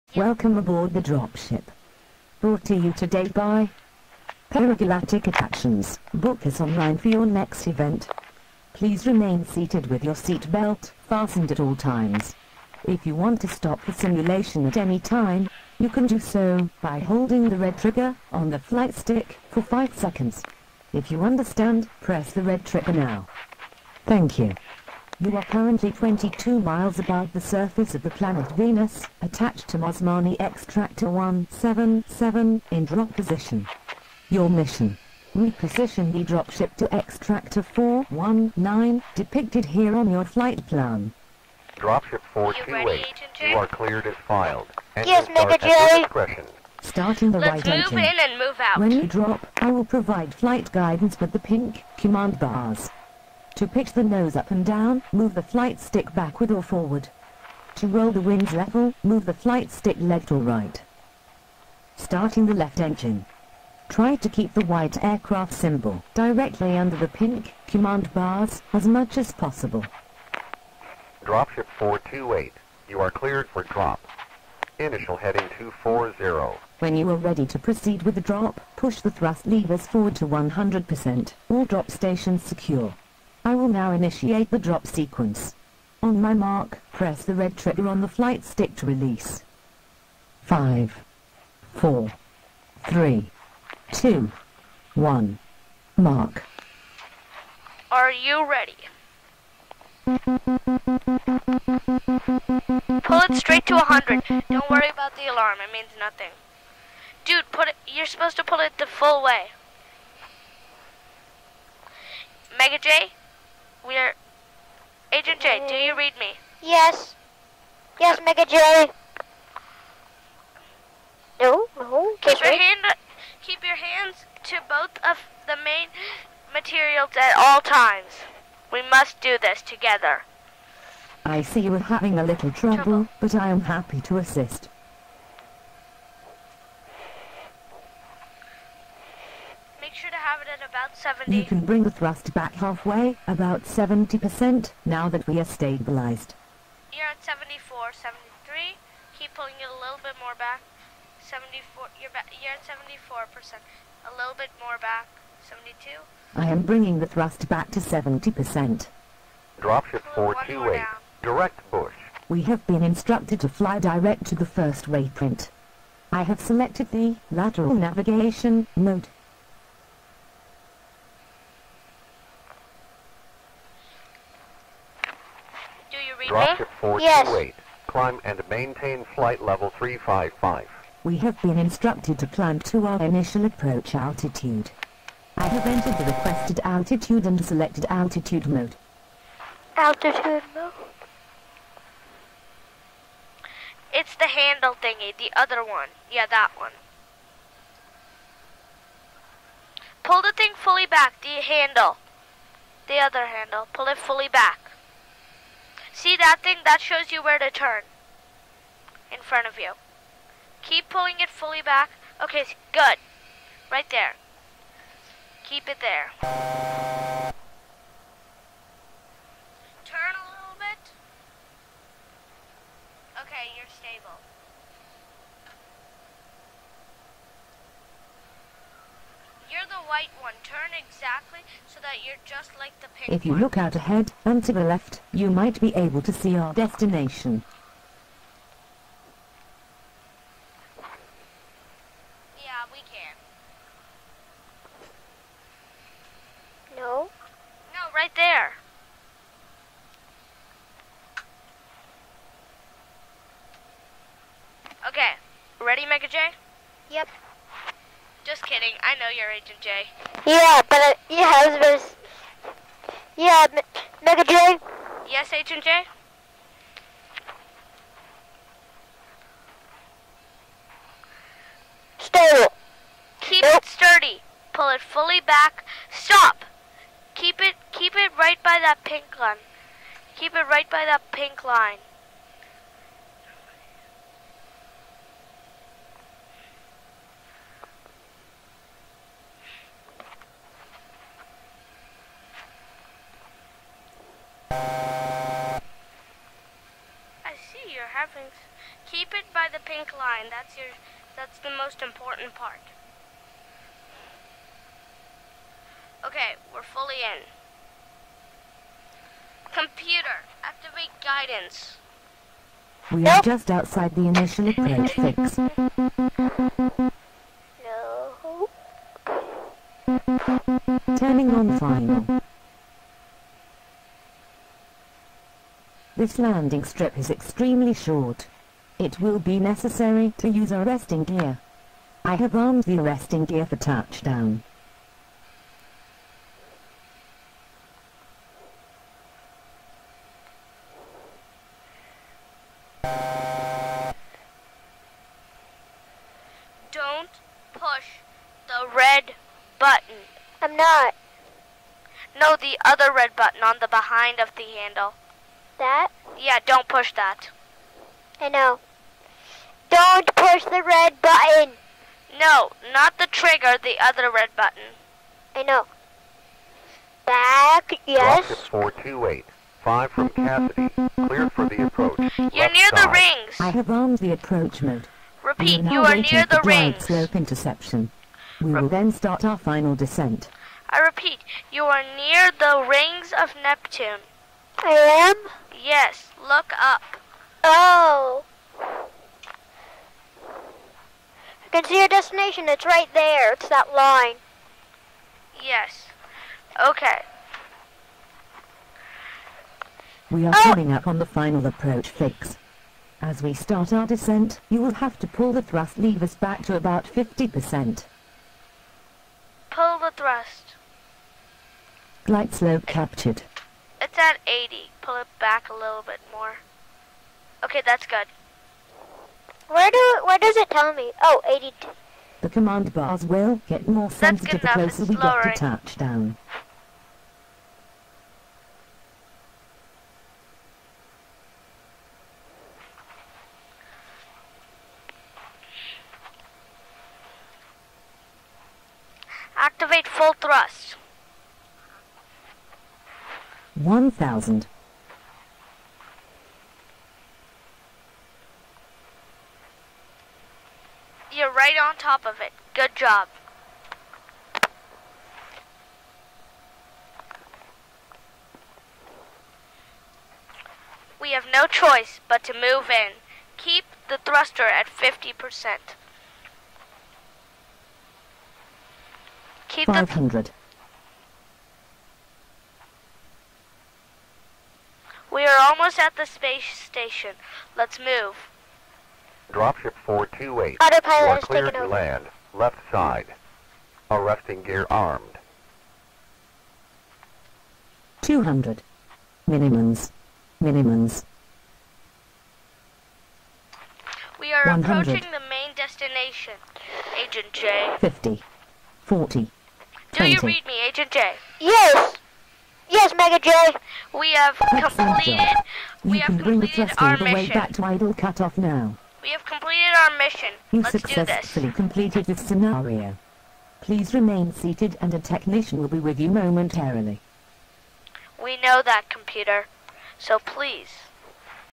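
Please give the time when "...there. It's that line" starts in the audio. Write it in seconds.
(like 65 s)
392 s.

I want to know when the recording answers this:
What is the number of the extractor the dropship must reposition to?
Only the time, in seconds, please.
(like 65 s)
36 s.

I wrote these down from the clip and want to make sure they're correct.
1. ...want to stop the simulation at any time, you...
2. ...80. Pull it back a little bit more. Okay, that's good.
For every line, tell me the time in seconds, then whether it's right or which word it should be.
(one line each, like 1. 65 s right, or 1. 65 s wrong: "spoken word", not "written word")
1. 13 s right
2. 414 s right.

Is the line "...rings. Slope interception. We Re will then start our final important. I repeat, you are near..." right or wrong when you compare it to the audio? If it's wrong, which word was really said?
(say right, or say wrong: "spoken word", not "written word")
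wrong: "descent", not "important".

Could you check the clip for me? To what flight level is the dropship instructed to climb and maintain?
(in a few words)
355.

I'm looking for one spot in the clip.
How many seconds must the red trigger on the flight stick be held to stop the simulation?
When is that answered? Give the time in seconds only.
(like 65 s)
19 s.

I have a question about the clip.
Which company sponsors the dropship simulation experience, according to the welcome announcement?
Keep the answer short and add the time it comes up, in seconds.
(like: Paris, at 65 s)
Paragalactic Attractions, at 4 s.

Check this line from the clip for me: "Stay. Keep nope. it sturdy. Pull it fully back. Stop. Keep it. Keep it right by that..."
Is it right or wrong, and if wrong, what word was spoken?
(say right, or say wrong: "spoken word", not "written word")
right.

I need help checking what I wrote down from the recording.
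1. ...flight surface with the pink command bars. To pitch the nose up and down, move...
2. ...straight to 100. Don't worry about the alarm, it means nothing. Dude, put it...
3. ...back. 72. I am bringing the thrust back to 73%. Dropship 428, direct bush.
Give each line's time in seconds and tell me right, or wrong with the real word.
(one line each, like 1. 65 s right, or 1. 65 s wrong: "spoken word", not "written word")
1. 50 s wrong: "guidance", not "surface"
2. 103 s right
3. 154 s wrong: "70", not "73".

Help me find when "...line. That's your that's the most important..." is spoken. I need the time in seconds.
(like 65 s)
299 s.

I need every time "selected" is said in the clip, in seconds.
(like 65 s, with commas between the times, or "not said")
166 s, 187 s.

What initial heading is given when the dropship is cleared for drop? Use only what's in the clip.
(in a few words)
240.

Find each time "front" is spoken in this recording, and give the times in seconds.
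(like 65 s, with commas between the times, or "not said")
209 s.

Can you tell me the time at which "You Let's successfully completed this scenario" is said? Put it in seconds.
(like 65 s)
510 s.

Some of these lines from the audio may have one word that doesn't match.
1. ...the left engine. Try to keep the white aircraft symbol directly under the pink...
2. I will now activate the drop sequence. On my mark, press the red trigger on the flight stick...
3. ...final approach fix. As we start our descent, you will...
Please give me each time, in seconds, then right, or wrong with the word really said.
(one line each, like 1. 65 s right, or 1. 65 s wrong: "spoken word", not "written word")
1. 62 s right
2. 83 s wrong: "initiate", not "activate"
3. 401 s right.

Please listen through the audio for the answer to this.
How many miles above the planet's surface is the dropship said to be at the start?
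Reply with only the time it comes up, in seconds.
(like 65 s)
25 s.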